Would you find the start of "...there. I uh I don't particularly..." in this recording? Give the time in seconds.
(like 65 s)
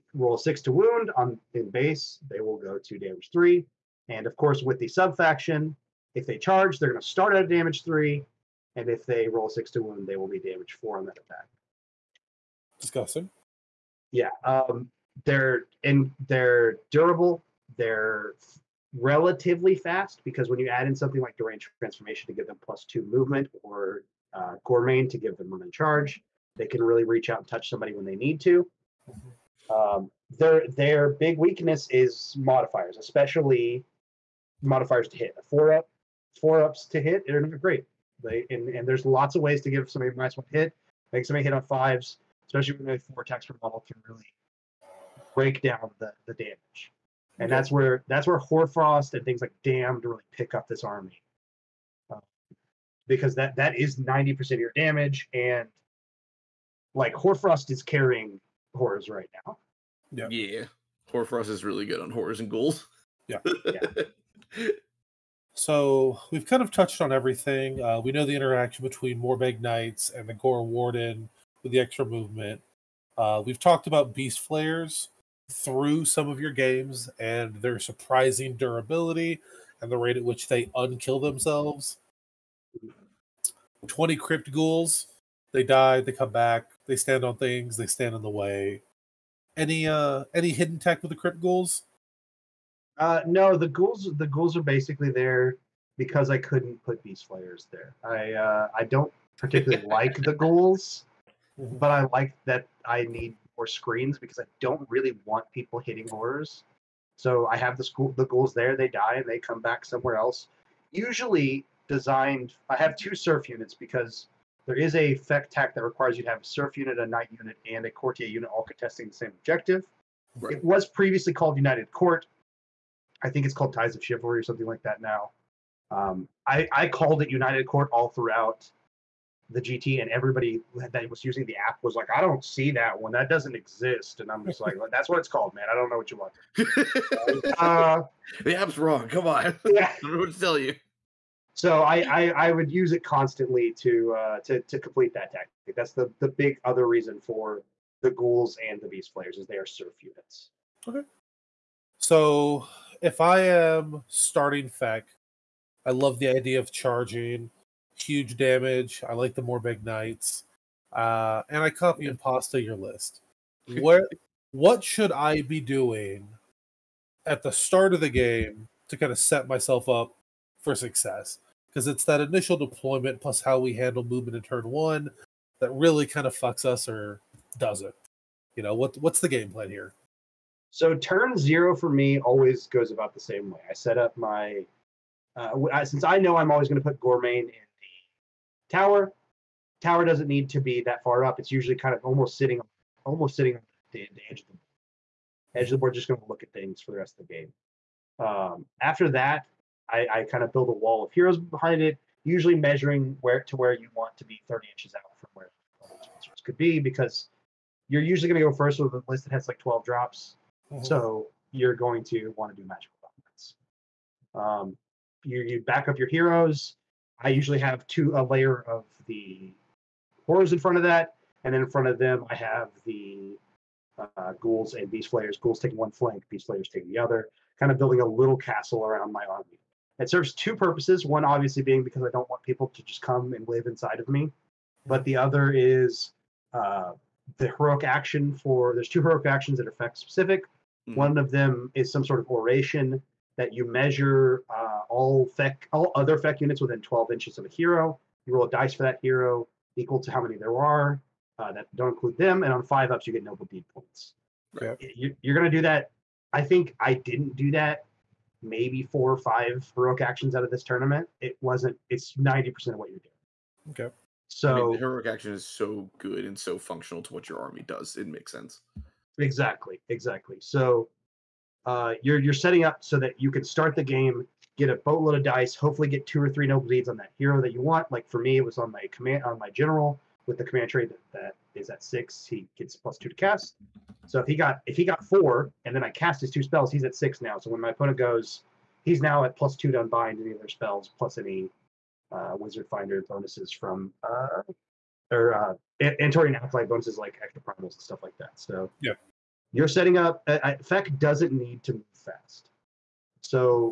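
97 s.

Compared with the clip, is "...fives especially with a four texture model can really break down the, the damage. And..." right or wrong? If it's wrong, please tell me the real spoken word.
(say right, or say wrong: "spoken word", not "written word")
right.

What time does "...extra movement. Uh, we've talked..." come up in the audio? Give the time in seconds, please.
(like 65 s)
71 s.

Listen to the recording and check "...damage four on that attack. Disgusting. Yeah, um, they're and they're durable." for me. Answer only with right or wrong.
right.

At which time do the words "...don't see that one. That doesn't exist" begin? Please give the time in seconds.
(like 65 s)
132 s.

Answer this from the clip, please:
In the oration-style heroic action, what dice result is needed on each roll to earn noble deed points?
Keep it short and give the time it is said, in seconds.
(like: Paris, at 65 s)
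5+, at 252 s.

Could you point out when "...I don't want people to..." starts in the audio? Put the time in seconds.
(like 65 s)
232 s.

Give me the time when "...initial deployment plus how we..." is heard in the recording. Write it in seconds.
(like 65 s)
172 s.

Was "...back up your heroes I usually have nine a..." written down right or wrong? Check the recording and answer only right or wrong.
wrong.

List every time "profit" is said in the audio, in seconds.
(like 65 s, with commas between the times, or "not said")
not said.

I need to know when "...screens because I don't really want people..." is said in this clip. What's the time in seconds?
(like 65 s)
103 s.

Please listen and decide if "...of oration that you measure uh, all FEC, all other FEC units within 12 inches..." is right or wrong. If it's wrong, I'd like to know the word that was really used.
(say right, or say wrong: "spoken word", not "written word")
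right.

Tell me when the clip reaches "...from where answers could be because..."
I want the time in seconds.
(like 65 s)
205 s.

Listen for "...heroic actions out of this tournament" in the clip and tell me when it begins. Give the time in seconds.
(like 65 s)
259 s.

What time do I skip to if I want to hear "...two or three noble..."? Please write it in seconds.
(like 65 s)
276 s.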